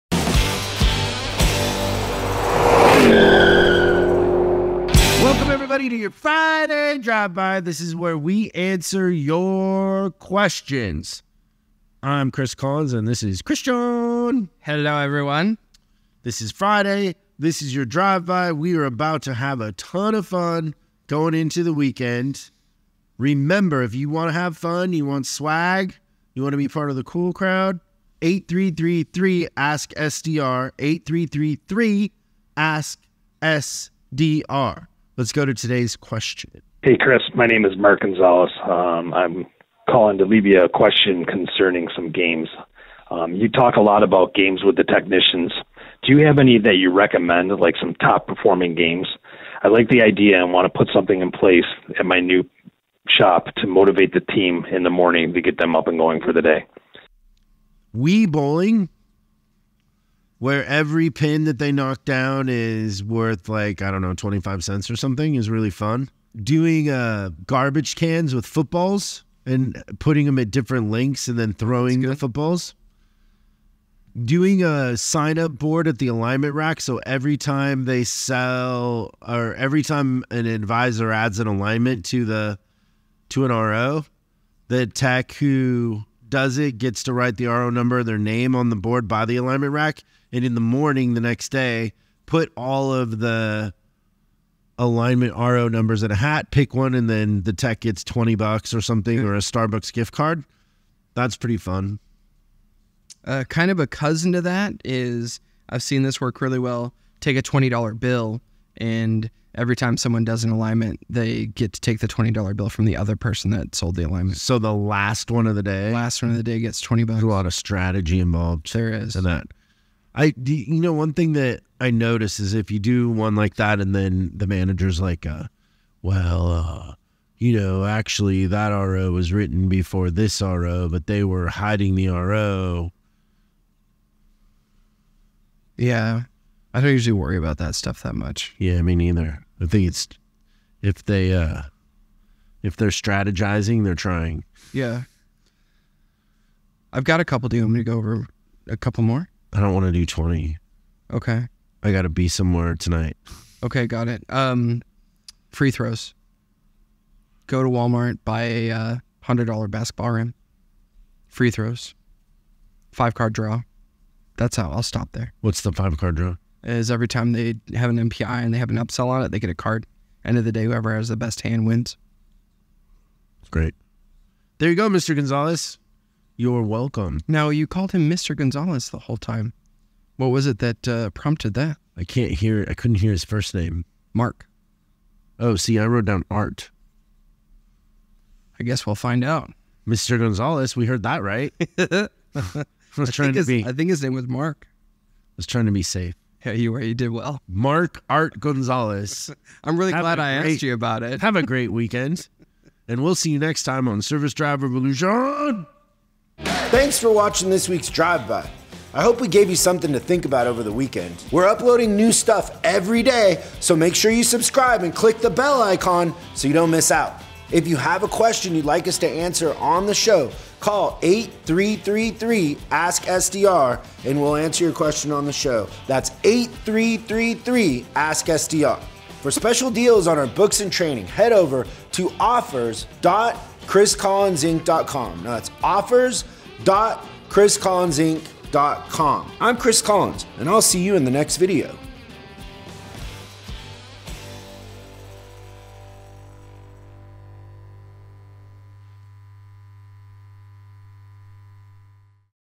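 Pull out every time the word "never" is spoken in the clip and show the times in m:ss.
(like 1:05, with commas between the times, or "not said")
not said.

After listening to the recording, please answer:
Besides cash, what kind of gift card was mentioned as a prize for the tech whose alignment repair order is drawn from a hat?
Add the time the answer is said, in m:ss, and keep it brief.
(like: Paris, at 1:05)
Starbucks, at 1:39.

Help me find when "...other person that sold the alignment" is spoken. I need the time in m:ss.
1:52.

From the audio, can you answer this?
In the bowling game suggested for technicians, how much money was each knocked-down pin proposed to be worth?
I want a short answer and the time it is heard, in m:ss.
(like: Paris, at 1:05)
25 cents, at 1:04.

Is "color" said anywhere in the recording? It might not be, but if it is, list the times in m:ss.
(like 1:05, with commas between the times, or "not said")
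not said.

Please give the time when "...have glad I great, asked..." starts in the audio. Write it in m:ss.
3:19.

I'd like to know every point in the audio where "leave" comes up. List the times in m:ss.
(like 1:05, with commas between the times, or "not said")
0:40.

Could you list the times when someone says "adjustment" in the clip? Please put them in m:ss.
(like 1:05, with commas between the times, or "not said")
not said.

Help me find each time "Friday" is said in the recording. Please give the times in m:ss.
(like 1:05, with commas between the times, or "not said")
0:06, 0:16.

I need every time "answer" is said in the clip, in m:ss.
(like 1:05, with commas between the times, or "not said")
0:08, 3:39, 3:44.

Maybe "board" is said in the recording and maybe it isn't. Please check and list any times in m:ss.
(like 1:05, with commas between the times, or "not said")
1:15, 1:28.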